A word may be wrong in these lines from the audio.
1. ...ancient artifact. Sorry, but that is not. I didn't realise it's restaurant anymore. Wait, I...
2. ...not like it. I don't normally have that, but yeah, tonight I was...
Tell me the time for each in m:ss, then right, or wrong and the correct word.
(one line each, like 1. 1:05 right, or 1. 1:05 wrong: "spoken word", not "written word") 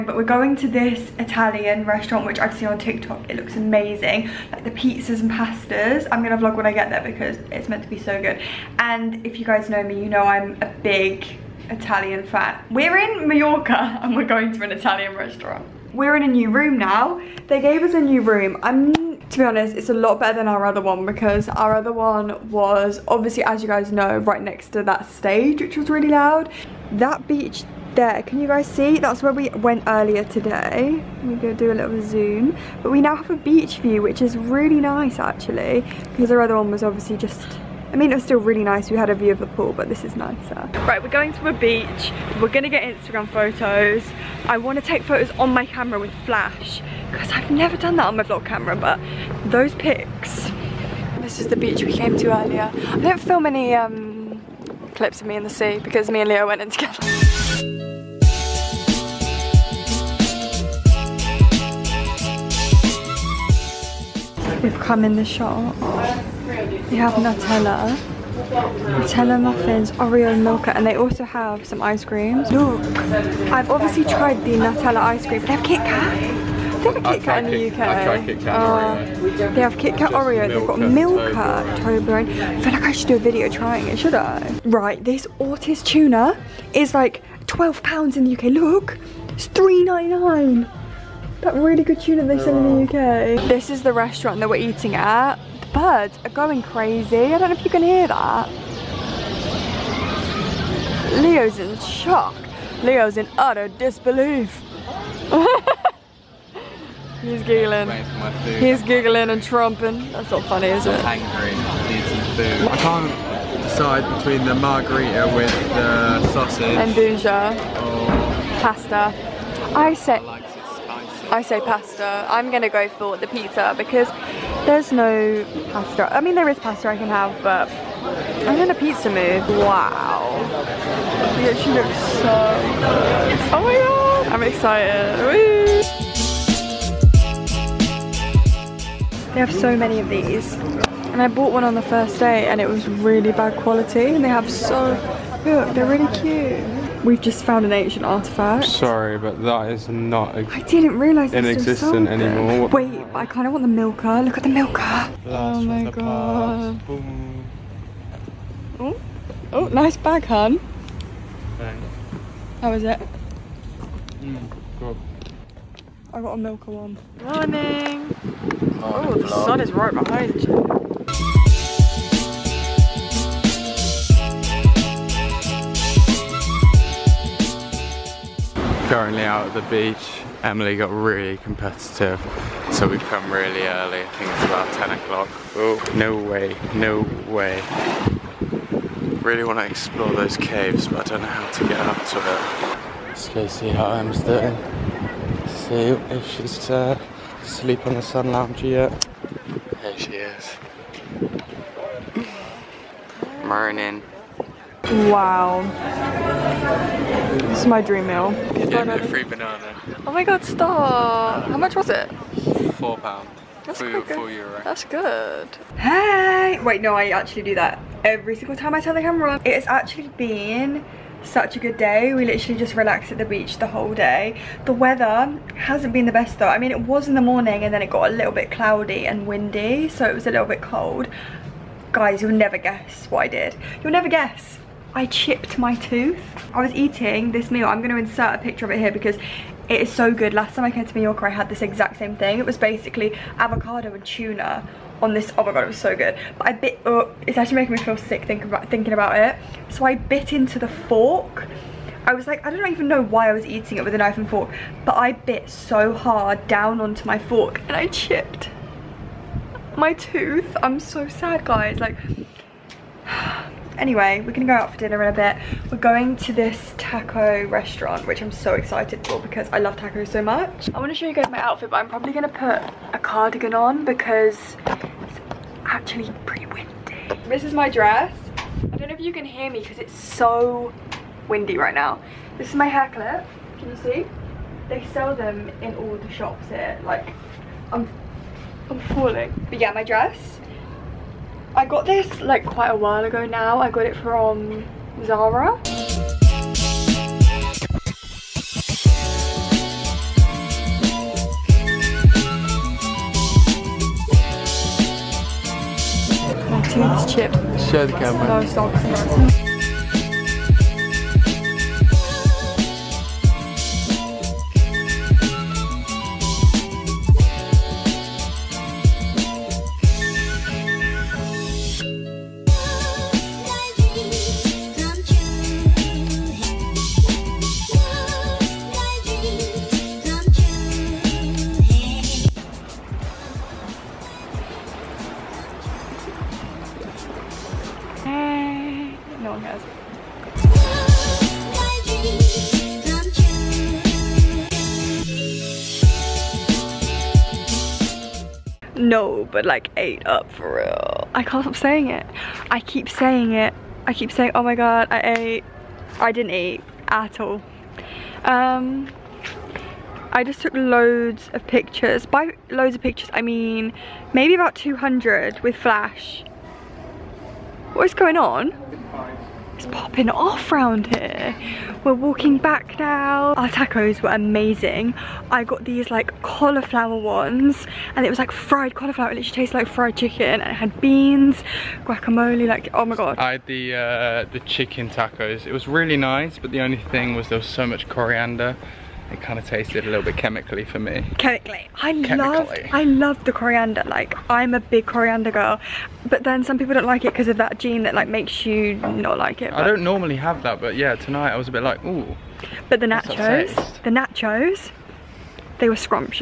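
1. 2:27 wrong: "existent", not "restaurant"
2. 6:38 right.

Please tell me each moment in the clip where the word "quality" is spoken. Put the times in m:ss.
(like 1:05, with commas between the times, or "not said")
2:23.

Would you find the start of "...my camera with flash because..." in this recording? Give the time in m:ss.
0:45.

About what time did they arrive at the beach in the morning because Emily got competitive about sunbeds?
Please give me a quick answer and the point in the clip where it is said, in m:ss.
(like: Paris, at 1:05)
10 o'clock, at 3:04.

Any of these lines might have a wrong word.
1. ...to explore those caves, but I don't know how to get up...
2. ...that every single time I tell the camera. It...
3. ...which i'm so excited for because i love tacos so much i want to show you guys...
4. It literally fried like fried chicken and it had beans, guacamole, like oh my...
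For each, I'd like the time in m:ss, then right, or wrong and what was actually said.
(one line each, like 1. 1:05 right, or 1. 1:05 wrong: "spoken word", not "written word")
1. 3:09 right
2. 3:37 right
3. 4:28 right
4. 6:19 wrong: "tasted", not "fried".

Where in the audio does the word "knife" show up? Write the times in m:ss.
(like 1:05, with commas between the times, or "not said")
4:13.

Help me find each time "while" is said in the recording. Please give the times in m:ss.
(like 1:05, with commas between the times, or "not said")
4:52.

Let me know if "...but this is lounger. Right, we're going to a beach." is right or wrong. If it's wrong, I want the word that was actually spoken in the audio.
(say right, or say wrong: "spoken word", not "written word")
wrong: "nicer", not "lounger".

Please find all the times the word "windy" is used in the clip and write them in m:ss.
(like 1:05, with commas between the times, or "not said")
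3:49, 4:36, 4:41.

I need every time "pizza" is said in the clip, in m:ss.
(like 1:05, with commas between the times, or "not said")
0:04, 2:03, 2:08.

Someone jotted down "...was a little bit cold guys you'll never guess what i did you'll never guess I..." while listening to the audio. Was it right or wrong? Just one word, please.
right.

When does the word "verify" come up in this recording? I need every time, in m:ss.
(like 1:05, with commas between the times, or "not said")
not said.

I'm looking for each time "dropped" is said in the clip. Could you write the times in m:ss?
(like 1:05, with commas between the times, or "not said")
not said.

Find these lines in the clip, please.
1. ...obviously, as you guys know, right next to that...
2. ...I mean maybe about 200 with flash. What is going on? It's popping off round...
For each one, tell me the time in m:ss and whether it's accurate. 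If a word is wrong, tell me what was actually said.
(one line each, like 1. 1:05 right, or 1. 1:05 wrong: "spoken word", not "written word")
1. 0:23 right
2. 6:03 right.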